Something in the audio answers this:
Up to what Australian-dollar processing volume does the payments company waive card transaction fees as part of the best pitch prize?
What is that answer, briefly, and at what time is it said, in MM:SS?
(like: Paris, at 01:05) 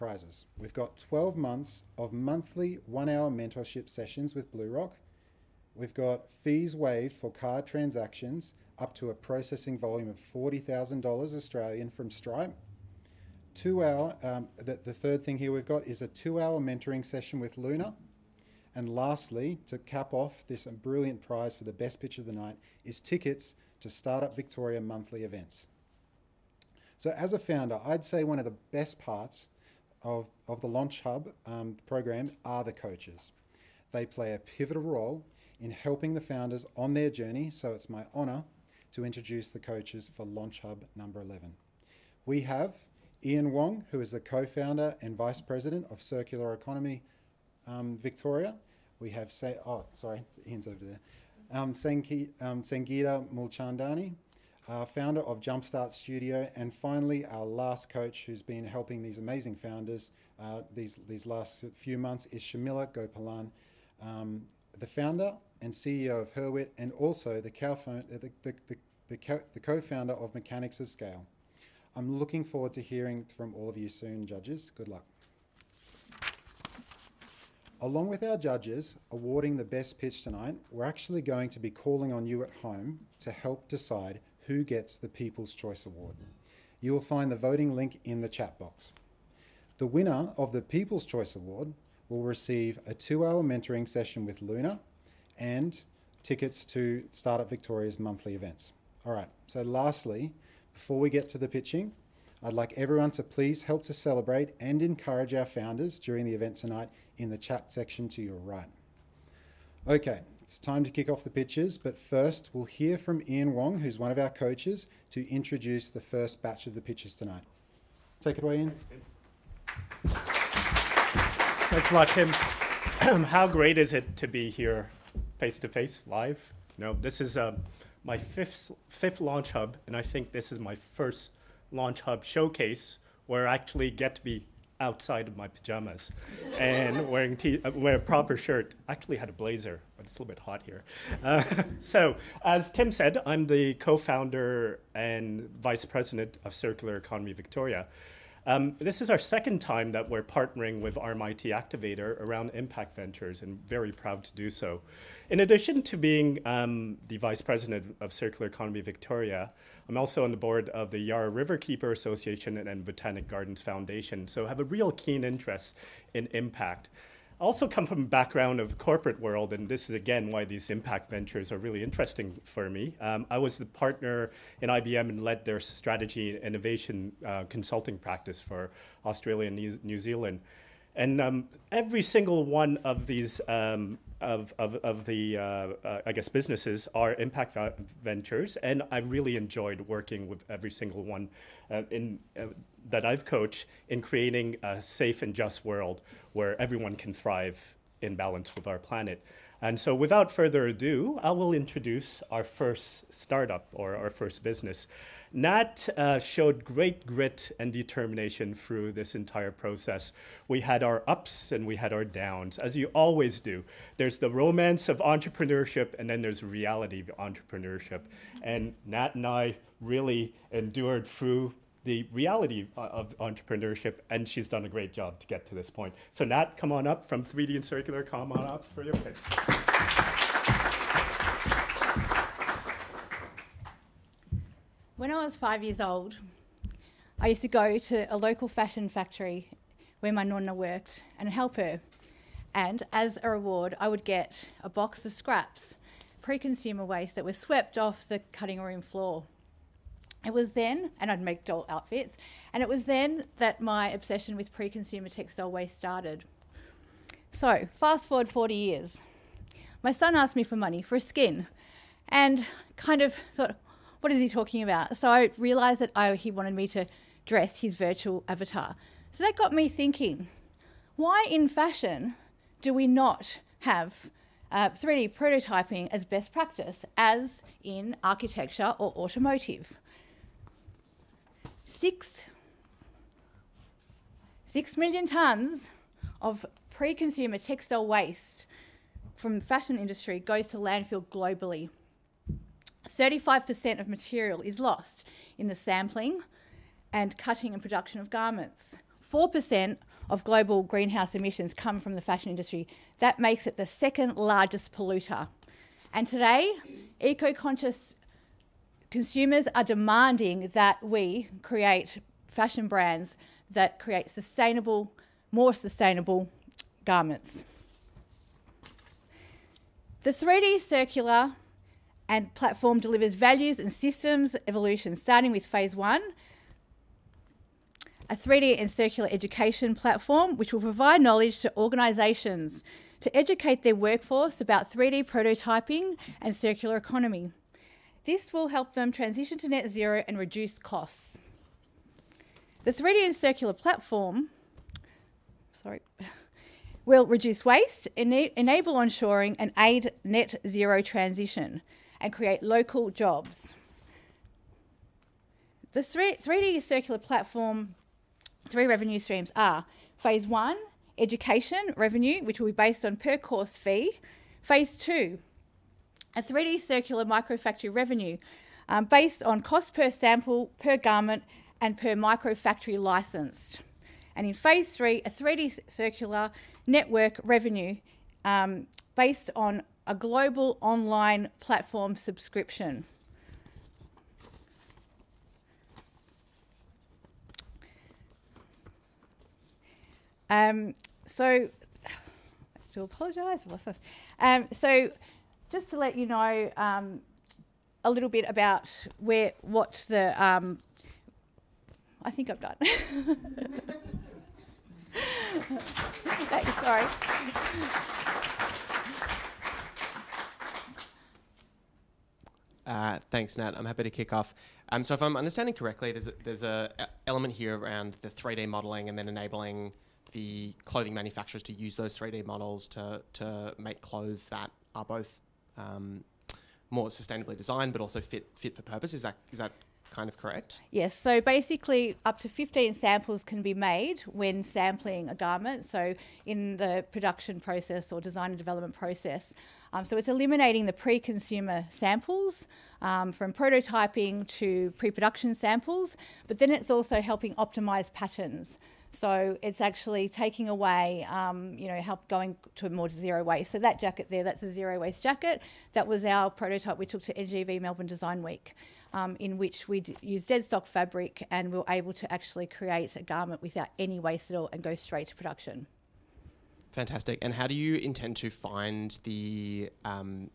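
$40,000, at 00:10.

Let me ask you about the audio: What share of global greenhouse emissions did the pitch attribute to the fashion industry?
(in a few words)
4%.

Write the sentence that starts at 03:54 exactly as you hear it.
When I was five years old, I used to go to a local fashion factory where my nonna worked and help her.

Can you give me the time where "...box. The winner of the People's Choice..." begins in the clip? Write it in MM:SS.
01:28.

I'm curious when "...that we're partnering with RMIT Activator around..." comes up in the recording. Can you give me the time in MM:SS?
02:29.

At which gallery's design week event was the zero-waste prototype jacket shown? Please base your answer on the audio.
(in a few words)
NGV Melbourne.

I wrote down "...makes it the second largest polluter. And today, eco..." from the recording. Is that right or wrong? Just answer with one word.
right.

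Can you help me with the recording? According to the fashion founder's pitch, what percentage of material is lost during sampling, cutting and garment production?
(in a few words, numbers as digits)
35%.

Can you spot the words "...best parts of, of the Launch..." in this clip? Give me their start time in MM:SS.
00:28.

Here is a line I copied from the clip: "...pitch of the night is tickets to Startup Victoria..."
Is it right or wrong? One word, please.
right.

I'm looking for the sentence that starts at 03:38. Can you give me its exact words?
And Nat and I really endured through the reality of entrepreneurship, and she's done a great job to get to this point.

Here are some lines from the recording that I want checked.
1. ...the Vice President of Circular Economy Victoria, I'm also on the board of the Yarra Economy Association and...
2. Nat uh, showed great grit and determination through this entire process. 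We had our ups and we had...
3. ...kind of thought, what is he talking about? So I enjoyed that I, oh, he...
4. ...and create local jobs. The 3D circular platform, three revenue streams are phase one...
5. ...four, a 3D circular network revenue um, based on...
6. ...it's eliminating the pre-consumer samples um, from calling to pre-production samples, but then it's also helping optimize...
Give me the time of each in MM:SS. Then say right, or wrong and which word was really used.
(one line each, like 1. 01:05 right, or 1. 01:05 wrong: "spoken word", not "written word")
1. 02:37 wrong: "Riverkeeper", not "Economy"
2. 03:25 right
3. 04:22 wrong: "realized", not "enjoyed"
4. 05:51 right
5. 06:14 wrong: "three", not "four"
6. 07:19 wrong: "prototyping", not "calling".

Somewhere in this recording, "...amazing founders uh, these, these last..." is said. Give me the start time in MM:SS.
00:59.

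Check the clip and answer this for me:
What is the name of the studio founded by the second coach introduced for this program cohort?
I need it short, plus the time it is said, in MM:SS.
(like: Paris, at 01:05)
Jumpstart Studio, at 00:55.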